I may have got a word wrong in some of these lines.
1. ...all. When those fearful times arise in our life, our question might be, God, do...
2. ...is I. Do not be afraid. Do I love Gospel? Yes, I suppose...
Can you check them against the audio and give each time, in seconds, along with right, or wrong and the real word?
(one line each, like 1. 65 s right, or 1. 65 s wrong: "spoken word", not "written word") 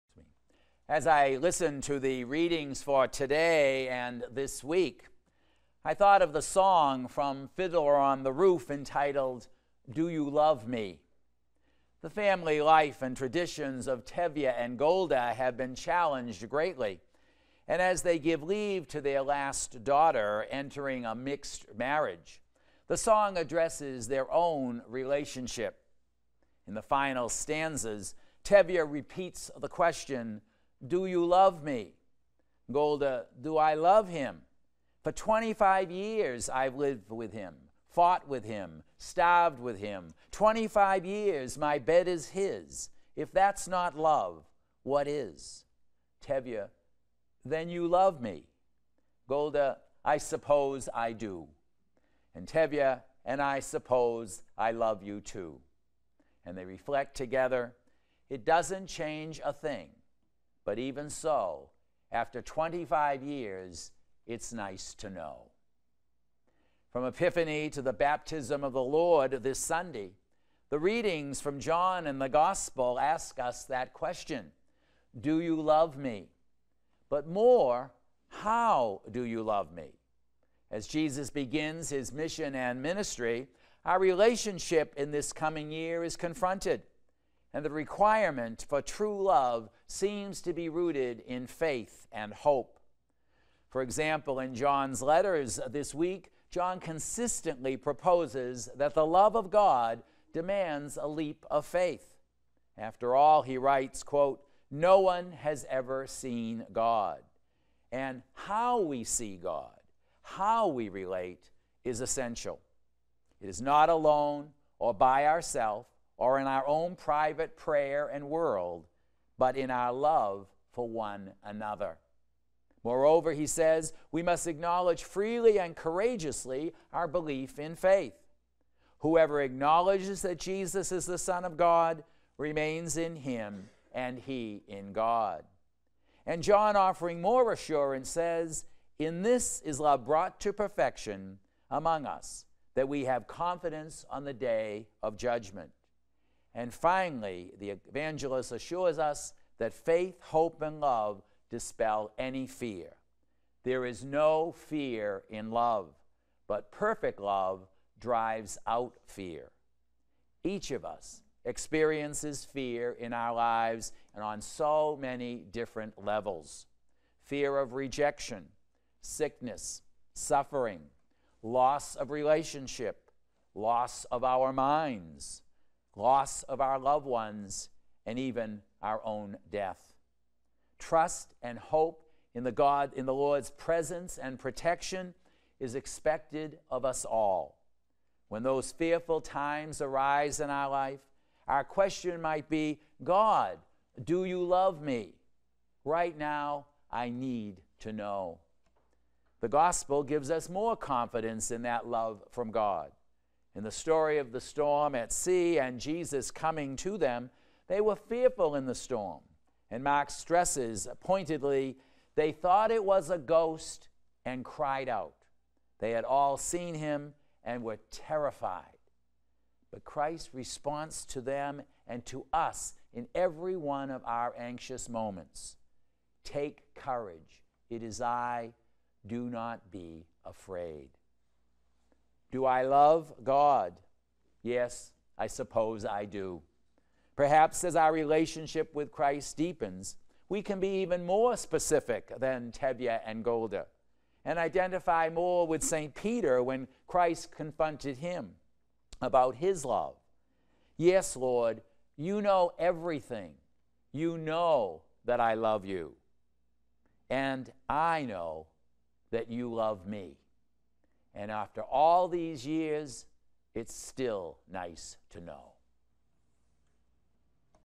1. 187 s right
2. 227 s wrong: "God", not "Gospel".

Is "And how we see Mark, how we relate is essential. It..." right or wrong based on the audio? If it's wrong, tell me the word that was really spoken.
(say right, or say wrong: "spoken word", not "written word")
wrong: "God", not "Mark".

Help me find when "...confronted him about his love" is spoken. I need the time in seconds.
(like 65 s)
247 s.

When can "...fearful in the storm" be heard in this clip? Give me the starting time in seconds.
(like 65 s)
207 s.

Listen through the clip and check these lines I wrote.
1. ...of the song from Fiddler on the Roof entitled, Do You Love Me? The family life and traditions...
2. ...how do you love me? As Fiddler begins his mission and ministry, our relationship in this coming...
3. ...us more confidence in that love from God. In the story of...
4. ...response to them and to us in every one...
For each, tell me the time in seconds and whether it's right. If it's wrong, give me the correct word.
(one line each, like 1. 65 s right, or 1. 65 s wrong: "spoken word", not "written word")
1. 6 s right
2. 78 s wrong: "Jesus", not "Fiddler"
3. 200 s right
4. 220 s right.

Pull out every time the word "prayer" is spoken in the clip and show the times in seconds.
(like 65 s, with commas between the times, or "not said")
117 s.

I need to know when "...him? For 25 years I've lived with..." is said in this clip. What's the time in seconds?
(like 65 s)
34 s.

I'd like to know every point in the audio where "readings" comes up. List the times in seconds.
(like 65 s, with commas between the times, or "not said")
2 s, 70 s.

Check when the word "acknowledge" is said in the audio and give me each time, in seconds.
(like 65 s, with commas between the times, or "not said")
124 s, 129 s.